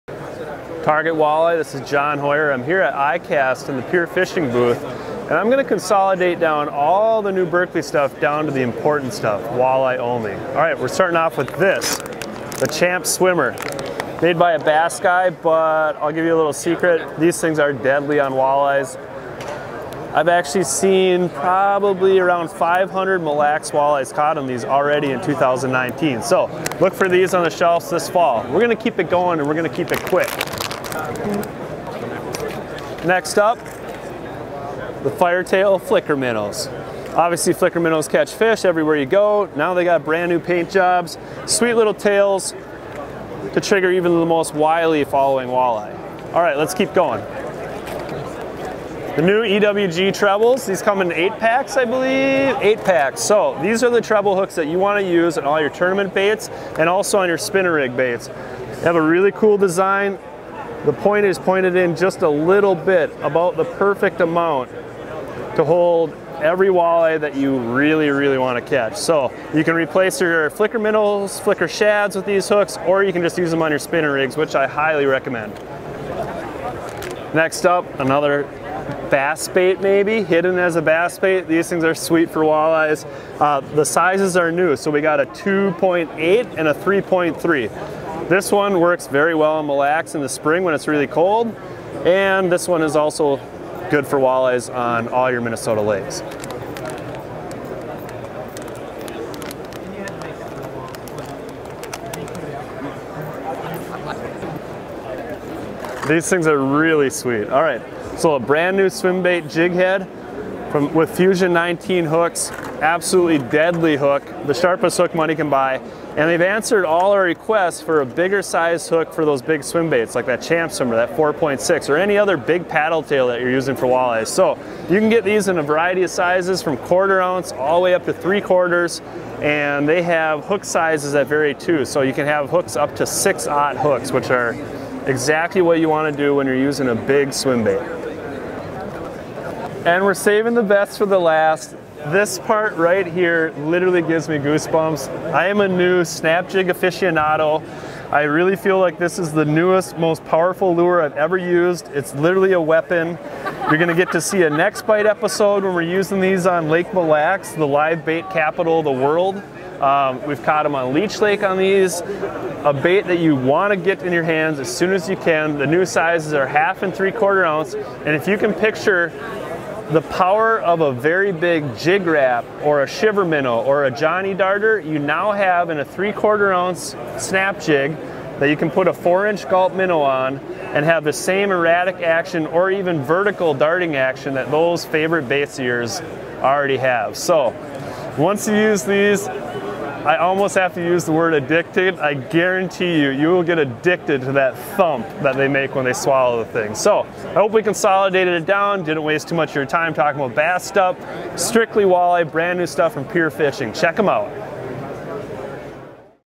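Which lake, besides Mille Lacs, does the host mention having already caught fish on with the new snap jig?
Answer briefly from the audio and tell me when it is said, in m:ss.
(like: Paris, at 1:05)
Leech Lake, at 2:40.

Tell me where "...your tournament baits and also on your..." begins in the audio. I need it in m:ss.
0:55.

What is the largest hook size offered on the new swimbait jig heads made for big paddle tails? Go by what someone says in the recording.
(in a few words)
6/0.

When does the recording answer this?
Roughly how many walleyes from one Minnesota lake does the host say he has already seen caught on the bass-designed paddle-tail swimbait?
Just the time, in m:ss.
0:22.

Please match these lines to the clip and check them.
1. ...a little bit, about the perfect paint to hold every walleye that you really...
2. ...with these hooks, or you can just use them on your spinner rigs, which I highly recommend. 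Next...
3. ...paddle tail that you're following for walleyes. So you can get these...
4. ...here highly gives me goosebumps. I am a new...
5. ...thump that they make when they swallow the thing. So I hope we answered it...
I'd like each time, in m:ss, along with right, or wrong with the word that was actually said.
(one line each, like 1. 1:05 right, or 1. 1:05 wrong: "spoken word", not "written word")
1. 1:02 wrong: "amount", not "paint"
2. 1:12 right
3. 2:02 wrong: "using", not "following"
4. 2:23 wrong: "literally", not "highly"
5. 3:14 wrong: "consolidated", not "answered".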